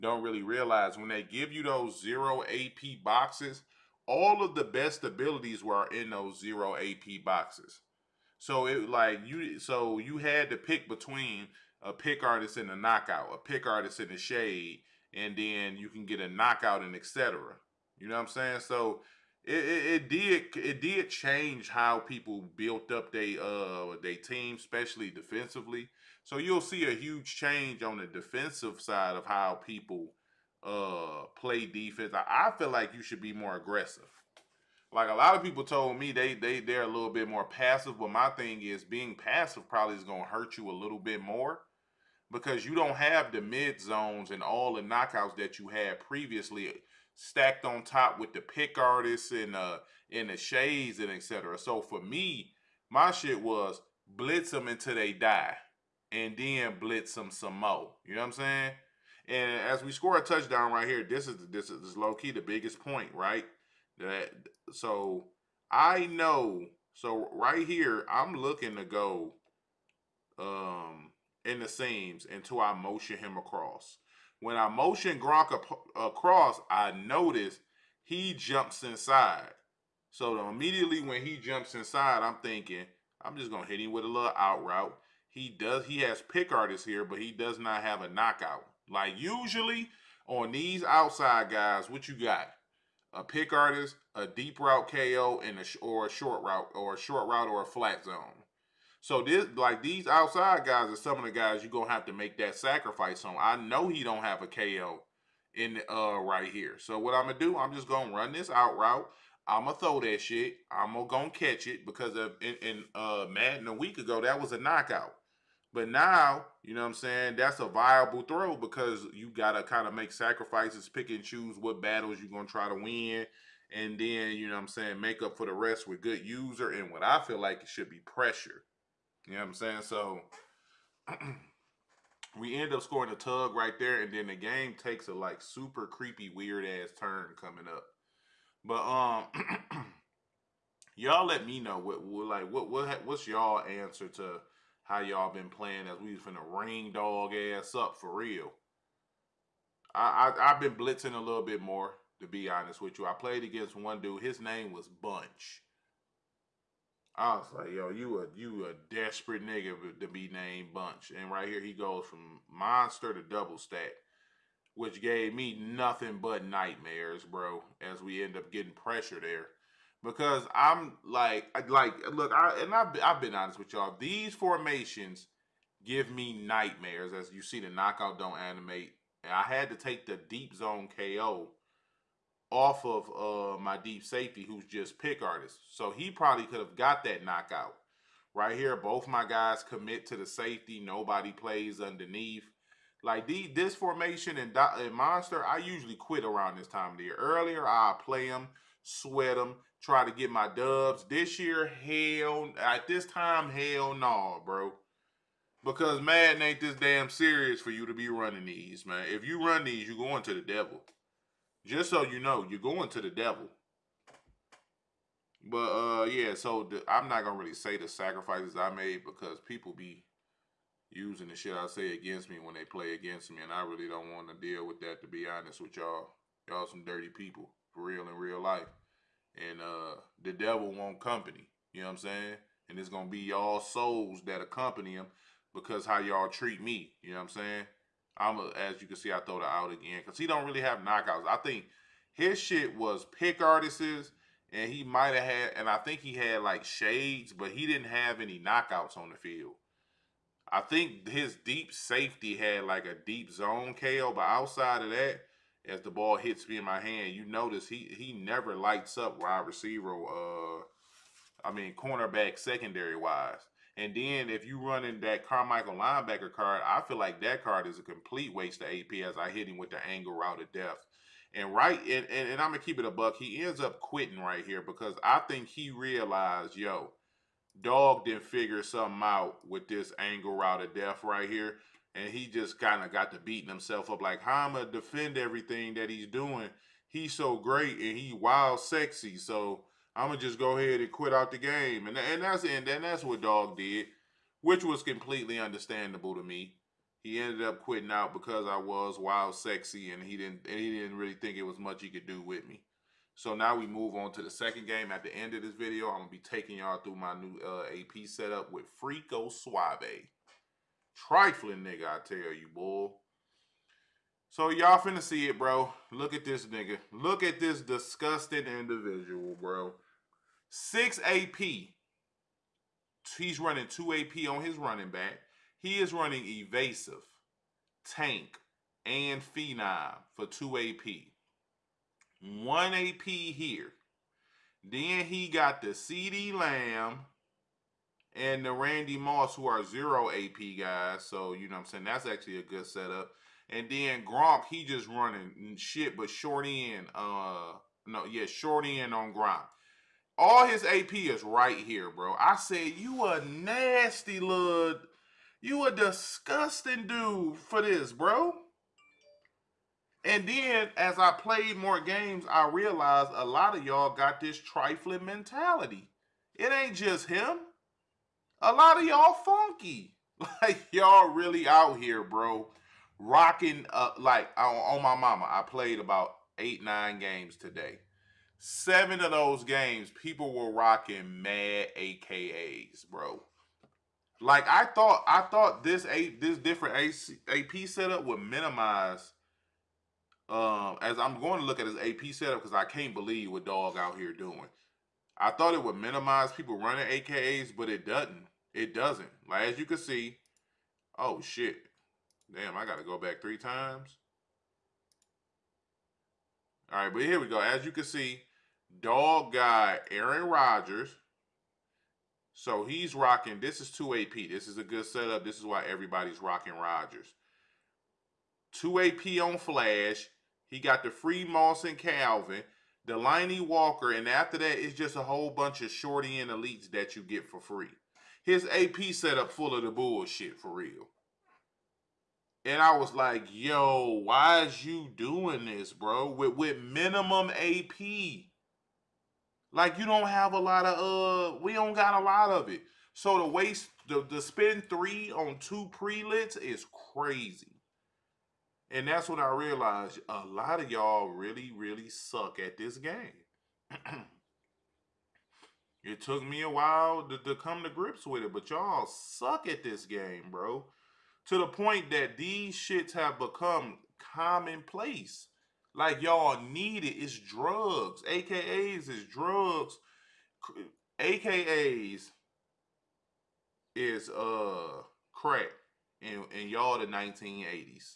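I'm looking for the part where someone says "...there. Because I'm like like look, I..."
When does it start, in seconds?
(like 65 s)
169 s.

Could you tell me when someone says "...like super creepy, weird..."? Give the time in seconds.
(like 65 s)
135 s.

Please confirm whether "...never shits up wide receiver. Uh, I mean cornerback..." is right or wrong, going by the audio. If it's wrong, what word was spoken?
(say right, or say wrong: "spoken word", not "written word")
wrong: "lights", not "shits".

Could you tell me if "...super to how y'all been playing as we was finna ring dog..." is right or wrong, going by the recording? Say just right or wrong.
wrong.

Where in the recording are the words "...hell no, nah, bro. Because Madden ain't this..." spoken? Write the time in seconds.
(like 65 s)
203 s.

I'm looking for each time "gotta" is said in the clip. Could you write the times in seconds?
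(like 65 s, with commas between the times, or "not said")
119 s, 402 s.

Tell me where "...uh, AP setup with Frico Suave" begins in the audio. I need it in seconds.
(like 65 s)
307 s.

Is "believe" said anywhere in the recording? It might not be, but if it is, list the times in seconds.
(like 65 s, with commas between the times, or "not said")
392 s.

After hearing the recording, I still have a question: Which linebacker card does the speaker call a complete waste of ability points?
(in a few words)
Carmichael.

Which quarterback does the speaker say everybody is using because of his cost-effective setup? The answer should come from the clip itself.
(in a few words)
Aaron Rodgers.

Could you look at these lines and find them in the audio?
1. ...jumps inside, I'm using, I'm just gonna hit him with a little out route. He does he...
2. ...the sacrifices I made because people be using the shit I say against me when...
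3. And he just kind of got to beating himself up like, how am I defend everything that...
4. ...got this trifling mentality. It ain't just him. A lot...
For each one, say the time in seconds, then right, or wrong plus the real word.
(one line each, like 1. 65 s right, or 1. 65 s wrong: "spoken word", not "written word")
1. 81 s wrong: "thinking", not "using"
2. 217 s right
3. 281 s right
4. 363 s right.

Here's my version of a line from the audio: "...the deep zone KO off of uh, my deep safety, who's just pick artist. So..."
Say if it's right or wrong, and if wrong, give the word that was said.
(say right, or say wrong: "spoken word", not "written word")
right.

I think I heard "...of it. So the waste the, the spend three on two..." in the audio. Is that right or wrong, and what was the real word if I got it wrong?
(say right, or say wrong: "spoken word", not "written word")
right.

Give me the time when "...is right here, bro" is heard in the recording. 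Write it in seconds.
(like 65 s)
350 s.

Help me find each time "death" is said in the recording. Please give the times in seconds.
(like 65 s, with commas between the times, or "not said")
270 s, 280 s.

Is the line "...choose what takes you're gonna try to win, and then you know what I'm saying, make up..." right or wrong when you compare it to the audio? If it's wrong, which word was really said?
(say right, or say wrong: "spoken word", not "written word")
wrong: "battles", not "takes".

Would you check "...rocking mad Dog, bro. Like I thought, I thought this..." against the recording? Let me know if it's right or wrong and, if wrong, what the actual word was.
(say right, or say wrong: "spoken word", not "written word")
wrong: "AKAs", not "Dog".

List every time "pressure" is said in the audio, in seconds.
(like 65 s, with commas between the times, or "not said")
127 s, 168 s.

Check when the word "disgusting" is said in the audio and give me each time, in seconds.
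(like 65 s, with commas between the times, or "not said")
317 s, 355 s.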